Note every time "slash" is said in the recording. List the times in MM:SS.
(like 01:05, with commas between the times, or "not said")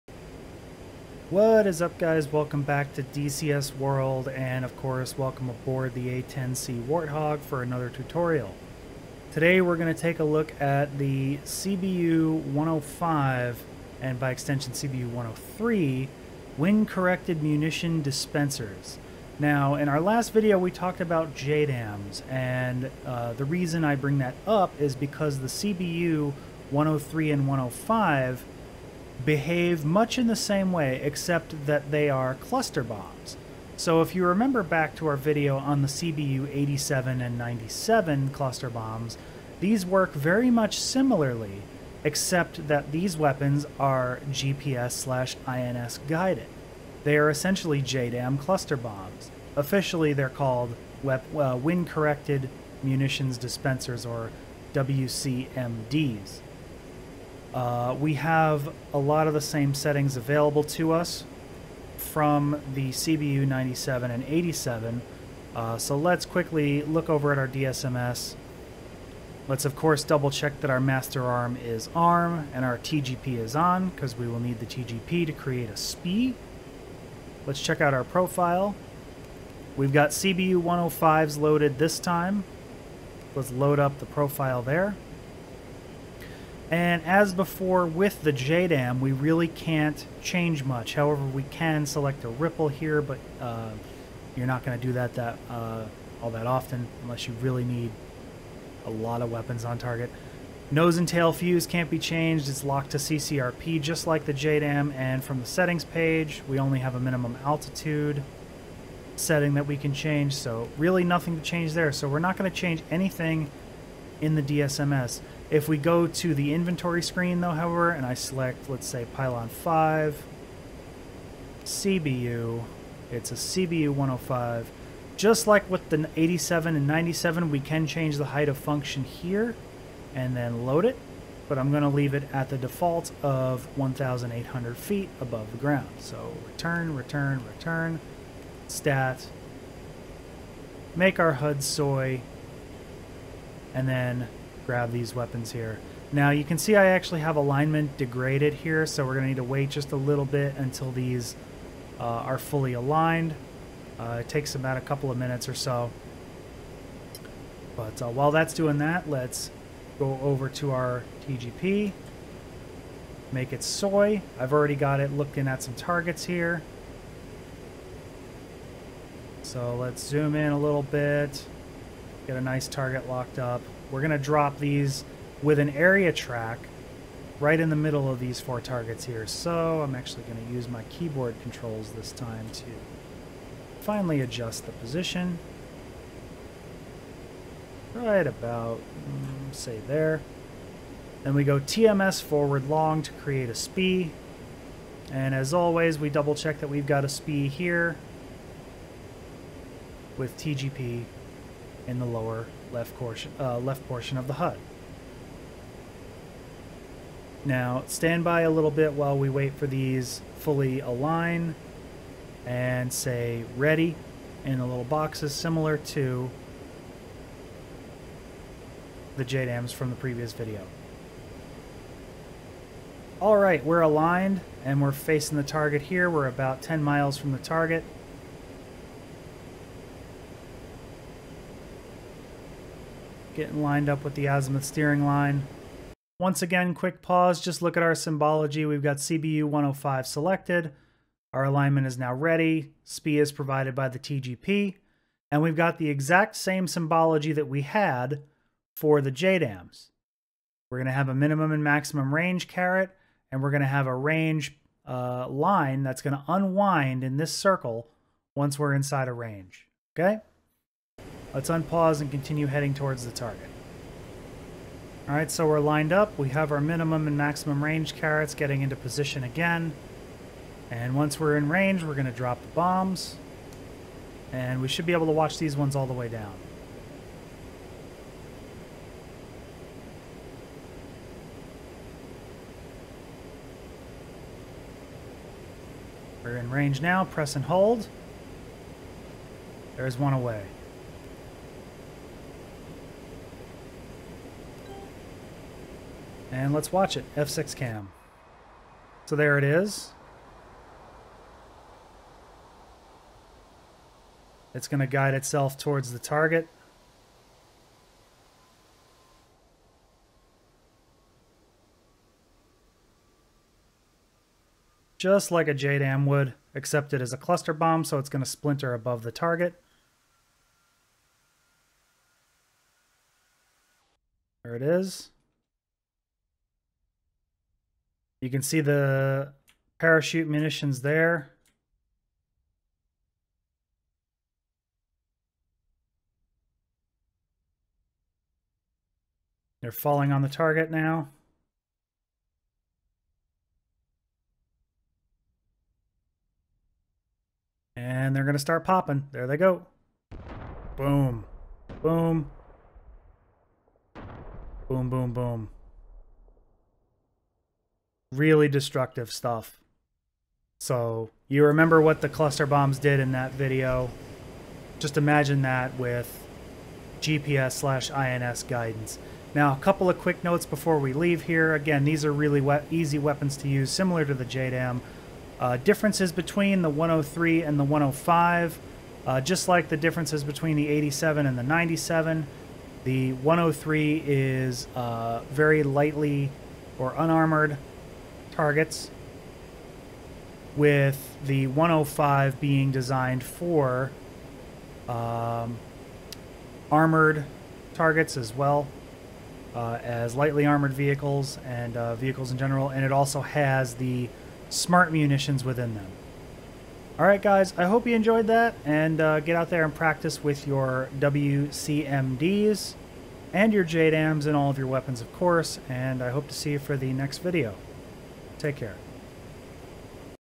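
00:44, 06:07.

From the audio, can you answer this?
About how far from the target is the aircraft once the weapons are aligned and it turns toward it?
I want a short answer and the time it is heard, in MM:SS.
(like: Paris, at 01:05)
10 miles, at 03:46.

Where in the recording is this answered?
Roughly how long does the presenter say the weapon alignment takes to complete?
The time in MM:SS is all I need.
02:34.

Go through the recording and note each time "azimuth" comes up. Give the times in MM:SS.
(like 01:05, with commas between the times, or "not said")
03:54.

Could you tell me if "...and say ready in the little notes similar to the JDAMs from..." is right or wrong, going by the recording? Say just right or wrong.
wrong.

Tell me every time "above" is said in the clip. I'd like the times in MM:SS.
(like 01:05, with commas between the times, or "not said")
02:15, 05:18.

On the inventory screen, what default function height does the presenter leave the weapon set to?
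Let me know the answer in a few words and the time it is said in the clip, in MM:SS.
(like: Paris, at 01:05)
1,800 feet, at 02:13.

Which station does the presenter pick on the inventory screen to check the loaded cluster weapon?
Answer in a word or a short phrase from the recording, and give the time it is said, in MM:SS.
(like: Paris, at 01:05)
Pylon 5, at 01:59.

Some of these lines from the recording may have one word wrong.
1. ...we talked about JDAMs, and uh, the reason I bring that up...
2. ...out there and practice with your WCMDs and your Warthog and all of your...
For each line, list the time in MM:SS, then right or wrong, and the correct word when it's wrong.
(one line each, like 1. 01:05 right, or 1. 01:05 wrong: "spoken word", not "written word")
1. 00:20 right
2. 06:49 wrong: "JDAMs", not "Warthog".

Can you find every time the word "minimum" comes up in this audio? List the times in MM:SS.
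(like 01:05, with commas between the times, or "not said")
01:47, 04:11, 04:26.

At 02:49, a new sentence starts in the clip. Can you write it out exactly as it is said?
So let's zoom in a little bit, get a nice target locked up.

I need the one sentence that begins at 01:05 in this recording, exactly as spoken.
Uh, so let's quickly look over at our DSMS.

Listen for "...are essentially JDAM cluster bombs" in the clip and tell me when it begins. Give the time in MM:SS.
00:47.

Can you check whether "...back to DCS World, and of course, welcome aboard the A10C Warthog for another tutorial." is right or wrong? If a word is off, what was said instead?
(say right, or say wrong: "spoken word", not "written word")
right.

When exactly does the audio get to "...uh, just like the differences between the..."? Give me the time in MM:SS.
06:19.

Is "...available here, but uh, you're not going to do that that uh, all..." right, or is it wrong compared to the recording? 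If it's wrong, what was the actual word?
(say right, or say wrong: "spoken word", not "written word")
wrong: "ripple", not "available".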